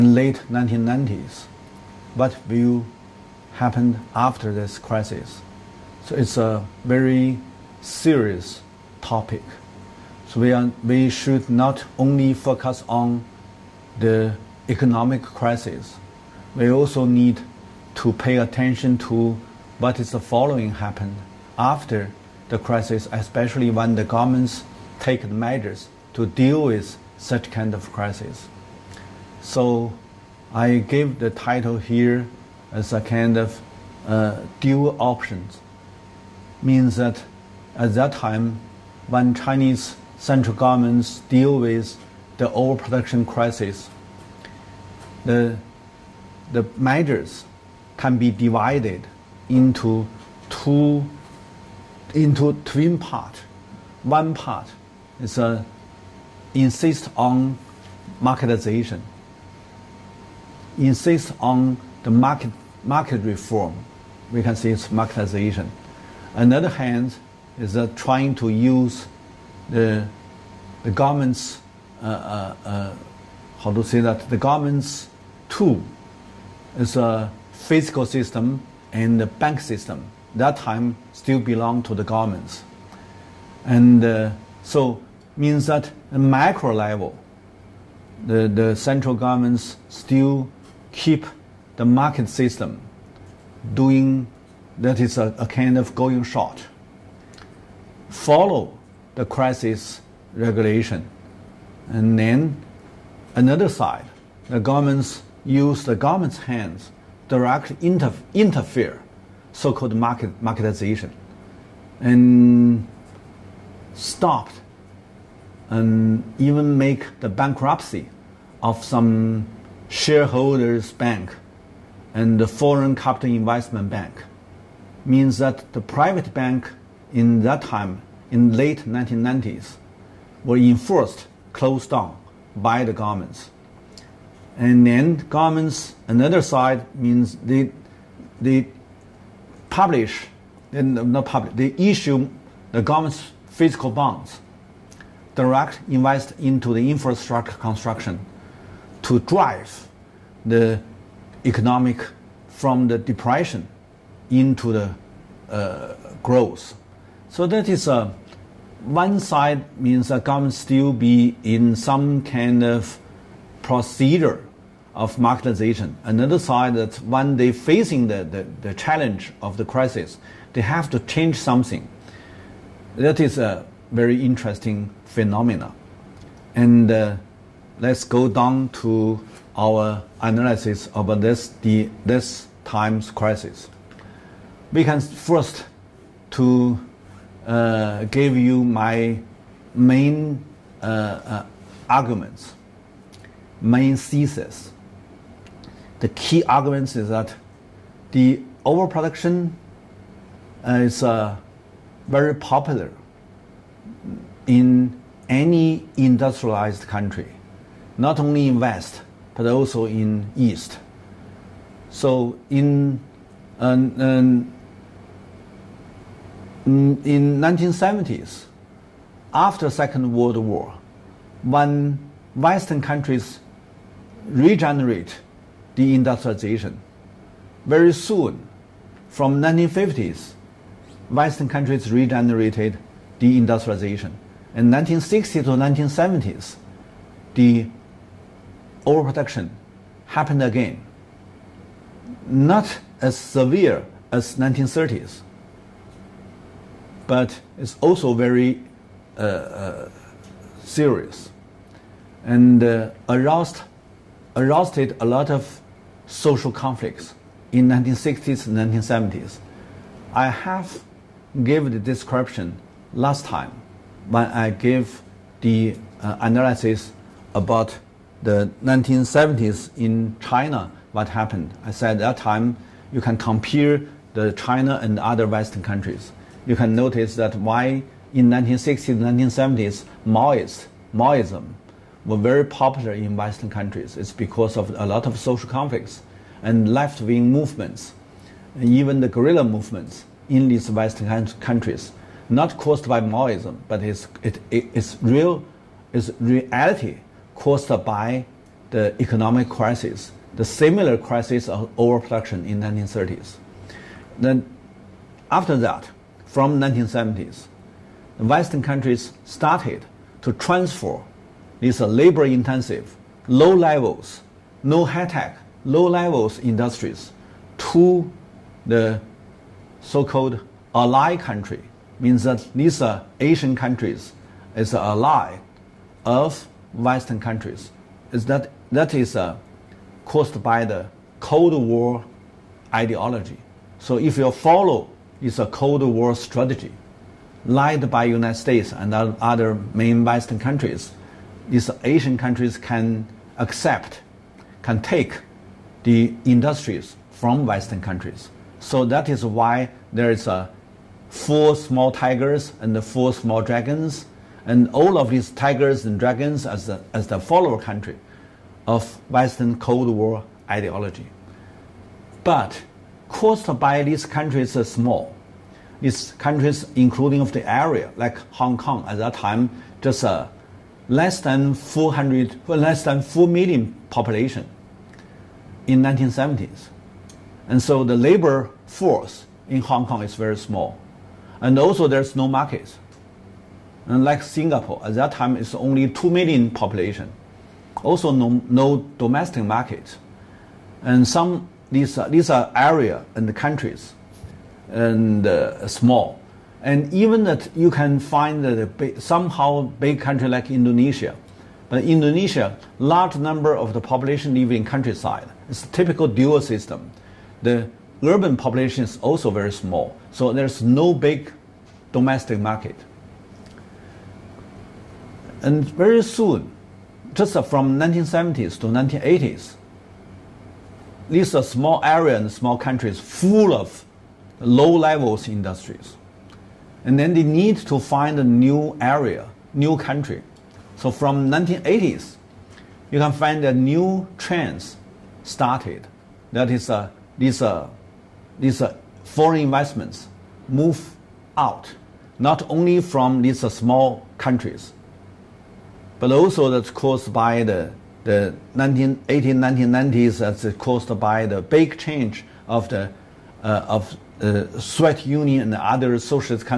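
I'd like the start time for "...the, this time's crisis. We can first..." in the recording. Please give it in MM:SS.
03:01.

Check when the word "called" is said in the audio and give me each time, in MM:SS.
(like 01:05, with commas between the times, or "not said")
01:49, 05:19.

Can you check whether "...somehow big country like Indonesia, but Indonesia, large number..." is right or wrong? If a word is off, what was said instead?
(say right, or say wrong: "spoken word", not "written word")
right.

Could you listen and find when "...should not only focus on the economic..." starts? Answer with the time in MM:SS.
00:11.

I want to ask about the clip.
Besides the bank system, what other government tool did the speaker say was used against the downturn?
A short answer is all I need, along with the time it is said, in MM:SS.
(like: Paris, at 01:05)
physical system, at 01:17.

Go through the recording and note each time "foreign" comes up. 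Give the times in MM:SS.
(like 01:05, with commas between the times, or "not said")
02:02, 07:19.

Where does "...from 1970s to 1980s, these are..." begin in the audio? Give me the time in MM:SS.
06:57.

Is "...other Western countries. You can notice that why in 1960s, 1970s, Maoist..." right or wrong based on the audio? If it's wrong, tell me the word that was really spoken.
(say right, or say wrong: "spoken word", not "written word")
right.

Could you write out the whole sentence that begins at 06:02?
But caused by these countries are small.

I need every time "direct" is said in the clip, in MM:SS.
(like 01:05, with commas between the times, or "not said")
01:47, 02:25.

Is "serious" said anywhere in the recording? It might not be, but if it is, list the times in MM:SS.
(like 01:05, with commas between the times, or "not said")
00:07, 04:10.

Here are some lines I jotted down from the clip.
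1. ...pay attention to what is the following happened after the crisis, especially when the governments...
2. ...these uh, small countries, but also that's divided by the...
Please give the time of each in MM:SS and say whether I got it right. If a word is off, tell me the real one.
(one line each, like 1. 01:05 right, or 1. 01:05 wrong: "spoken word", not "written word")
1. 00:18 right
2. 07:23 wrong: "caused", not "divided".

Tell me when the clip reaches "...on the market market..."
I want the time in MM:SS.
01:01.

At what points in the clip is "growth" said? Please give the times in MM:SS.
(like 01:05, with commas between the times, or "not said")
02:36.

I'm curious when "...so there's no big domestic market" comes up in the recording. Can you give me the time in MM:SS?
06:50.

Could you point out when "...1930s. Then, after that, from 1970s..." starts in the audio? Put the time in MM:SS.
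05:02.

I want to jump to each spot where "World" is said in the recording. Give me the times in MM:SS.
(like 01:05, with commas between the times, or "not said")
03:40.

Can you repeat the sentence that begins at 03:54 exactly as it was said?
In 1960s to 1970s, the overproduction happened again.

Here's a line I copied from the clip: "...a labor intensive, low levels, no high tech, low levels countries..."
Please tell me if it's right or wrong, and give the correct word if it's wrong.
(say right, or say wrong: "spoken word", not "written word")
wrong: "industries", not "countries".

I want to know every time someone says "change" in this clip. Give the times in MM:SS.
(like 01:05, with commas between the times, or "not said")
02:51, 07:31.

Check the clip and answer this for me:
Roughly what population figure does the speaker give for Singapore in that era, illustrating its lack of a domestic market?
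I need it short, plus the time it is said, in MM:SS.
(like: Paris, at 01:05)
2 million, at 06:25.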